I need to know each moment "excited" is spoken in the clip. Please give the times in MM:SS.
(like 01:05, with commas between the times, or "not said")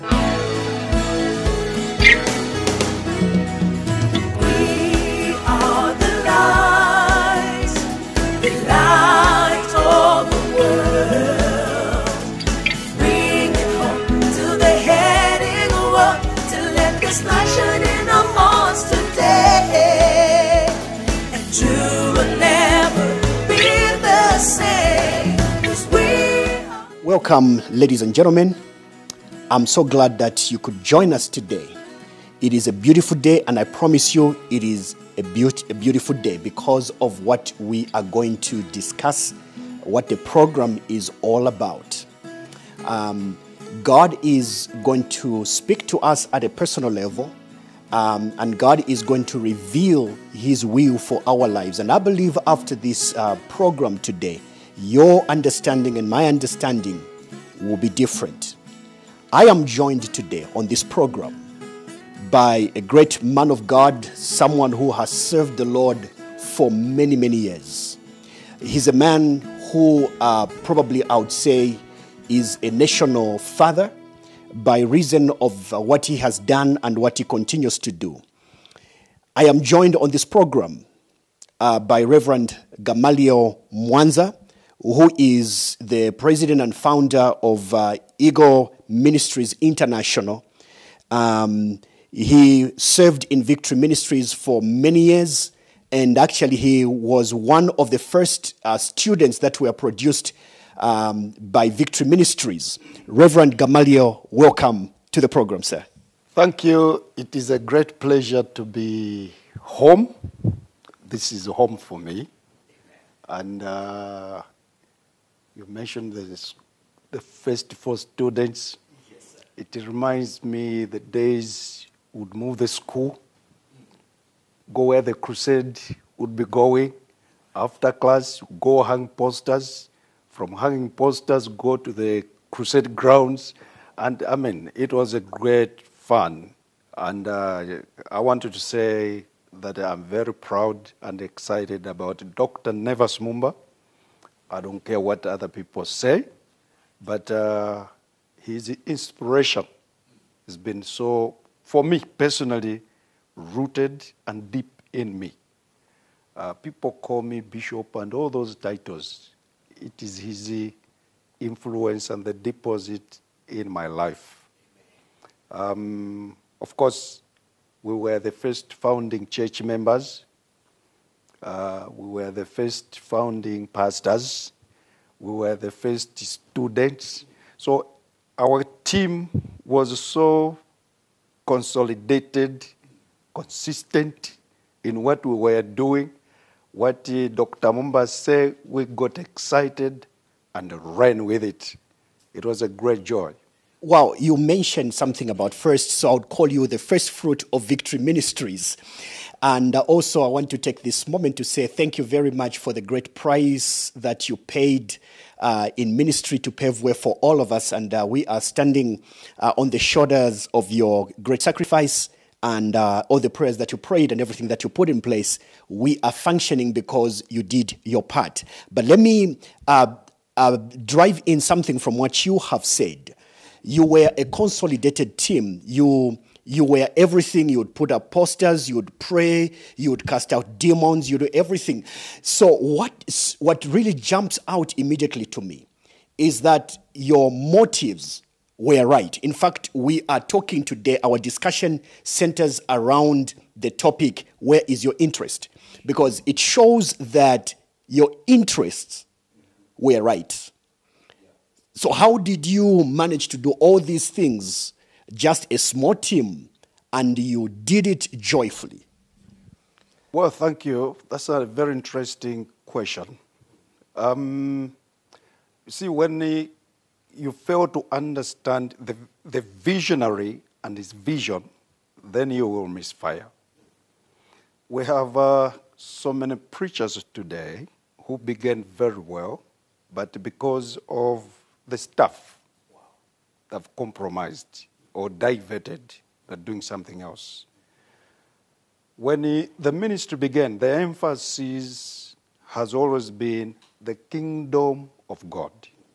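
02:21, 03:09.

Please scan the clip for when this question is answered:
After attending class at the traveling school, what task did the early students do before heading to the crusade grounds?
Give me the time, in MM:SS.
02:08.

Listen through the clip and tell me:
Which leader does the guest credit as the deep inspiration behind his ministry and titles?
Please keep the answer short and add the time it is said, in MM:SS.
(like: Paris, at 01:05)
Dr. Nevers Mumba, at 02:22.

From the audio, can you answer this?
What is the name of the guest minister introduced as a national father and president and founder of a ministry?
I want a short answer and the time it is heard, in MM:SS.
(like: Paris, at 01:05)
Gamaliel Mwanza, at 01:22.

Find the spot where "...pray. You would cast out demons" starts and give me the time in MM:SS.
03:49.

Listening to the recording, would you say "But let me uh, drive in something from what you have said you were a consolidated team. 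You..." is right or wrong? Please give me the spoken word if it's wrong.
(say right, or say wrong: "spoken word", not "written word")
right.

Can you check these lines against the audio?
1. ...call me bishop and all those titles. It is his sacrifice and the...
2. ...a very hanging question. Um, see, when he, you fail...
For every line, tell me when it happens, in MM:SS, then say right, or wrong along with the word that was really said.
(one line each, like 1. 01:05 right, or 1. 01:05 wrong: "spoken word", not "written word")
1. 02:36 wrong: "influence", not "sacrifice"
2. 04:21 wrong: "interesting", not "hanging".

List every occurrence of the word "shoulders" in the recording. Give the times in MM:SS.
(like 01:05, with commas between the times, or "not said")
03:29.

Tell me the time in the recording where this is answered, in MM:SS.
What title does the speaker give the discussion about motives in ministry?
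04:04.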